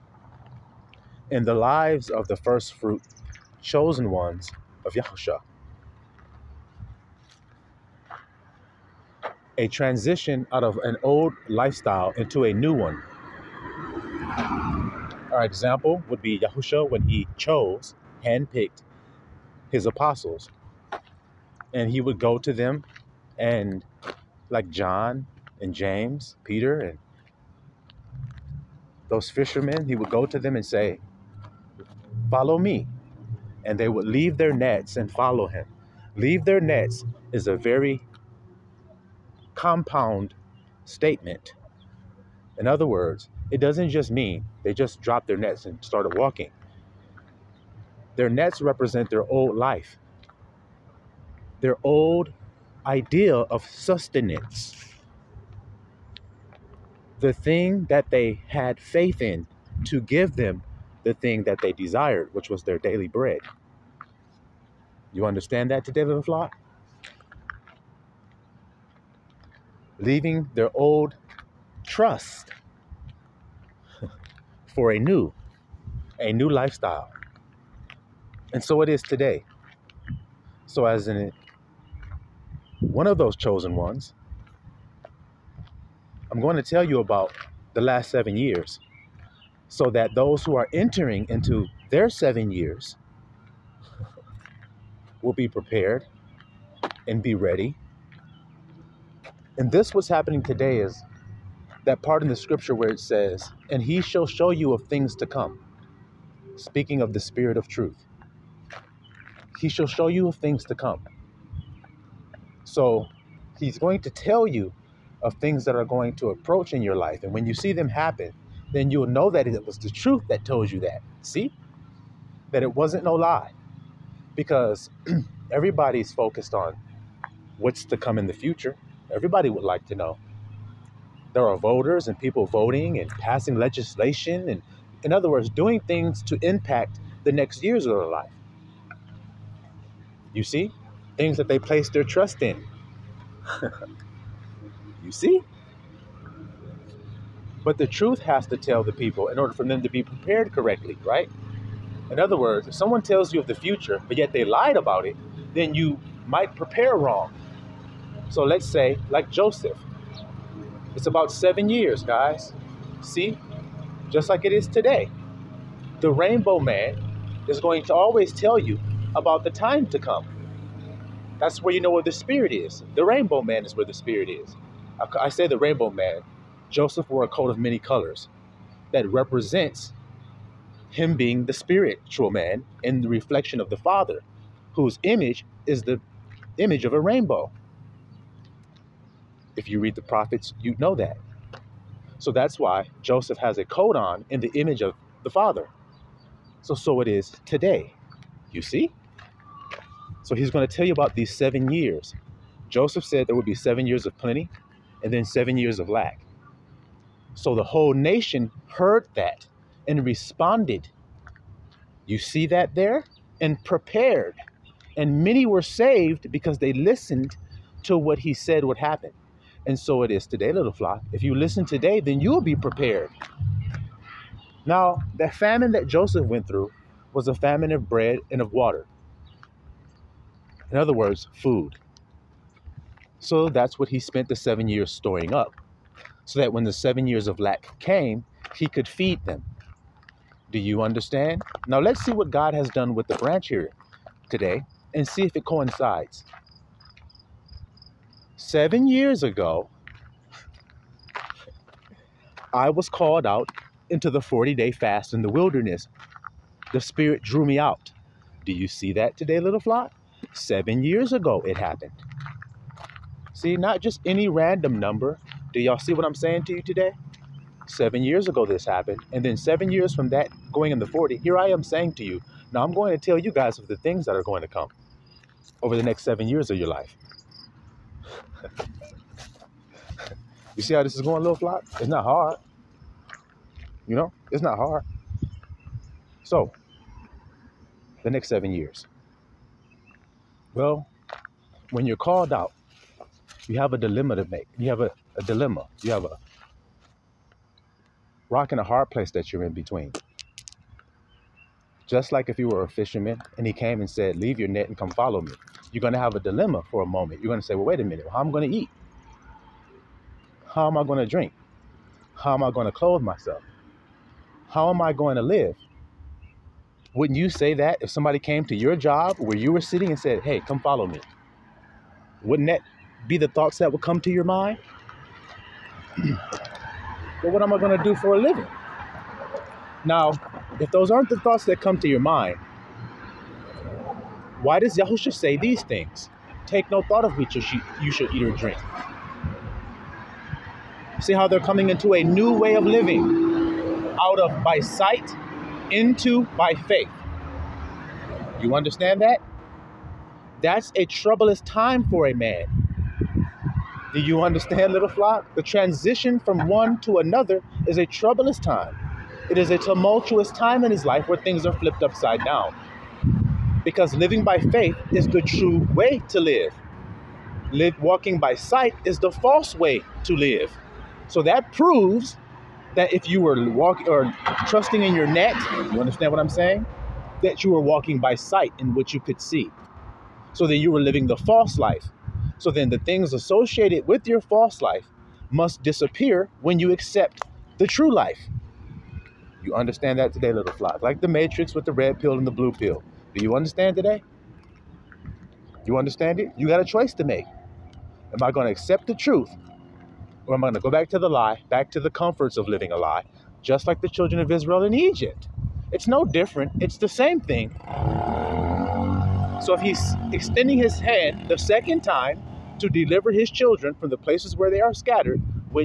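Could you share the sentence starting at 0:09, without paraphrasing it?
A transition out of an old lifestyle into a new one.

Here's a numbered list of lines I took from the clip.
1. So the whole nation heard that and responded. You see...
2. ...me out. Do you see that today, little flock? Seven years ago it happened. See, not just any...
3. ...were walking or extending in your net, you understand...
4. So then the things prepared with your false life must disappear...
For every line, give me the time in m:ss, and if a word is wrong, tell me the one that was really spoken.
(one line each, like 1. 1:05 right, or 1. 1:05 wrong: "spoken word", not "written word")
1. 3:27 right
2. 4:17 right
3. 6:13 wrong: "trusting", not "extending"
4. 6:22 wrong: "associated", not "prepared".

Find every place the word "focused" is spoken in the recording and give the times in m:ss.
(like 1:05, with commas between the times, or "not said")
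2:06.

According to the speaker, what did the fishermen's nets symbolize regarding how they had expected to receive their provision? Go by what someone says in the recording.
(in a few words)
Their old idea of sustenance.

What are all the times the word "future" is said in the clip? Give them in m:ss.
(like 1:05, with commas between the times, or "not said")
2:08, 2:33.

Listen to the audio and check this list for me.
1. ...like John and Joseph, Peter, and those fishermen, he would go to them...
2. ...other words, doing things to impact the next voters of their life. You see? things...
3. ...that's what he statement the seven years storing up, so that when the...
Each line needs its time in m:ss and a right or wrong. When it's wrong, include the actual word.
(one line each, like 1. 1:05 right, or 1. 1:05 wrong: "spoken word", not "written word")
1. 0:24 wrong: "James", not "Joseph"
2. 2:15 wrong: "years", not "voters"
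3. 3:53 wrong: "spent", not "statement".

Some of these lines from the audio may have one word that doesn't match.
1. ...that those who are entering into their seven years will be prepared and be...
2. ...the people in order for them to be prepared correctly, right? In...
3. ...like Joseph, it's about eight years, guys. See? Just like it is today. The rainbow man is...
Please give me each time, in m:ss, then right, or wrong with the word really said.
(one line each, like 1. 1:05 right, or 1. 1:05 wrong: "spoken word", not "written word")
1. 1:29 right
2. 2:28 right
3. 2:39 wrong: "seven", not "eight".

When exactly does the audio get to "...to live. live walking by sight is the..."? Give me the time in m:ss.
6:06.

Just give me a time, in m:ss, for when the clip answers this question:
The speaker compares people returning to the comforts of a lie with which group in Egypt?
6:43.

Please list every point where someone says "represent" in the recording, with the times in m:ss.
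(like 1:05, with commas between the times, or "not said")
0:48, 2:59.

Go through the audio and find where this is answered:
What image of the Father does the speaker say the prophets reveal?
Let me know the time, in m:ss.
3:06.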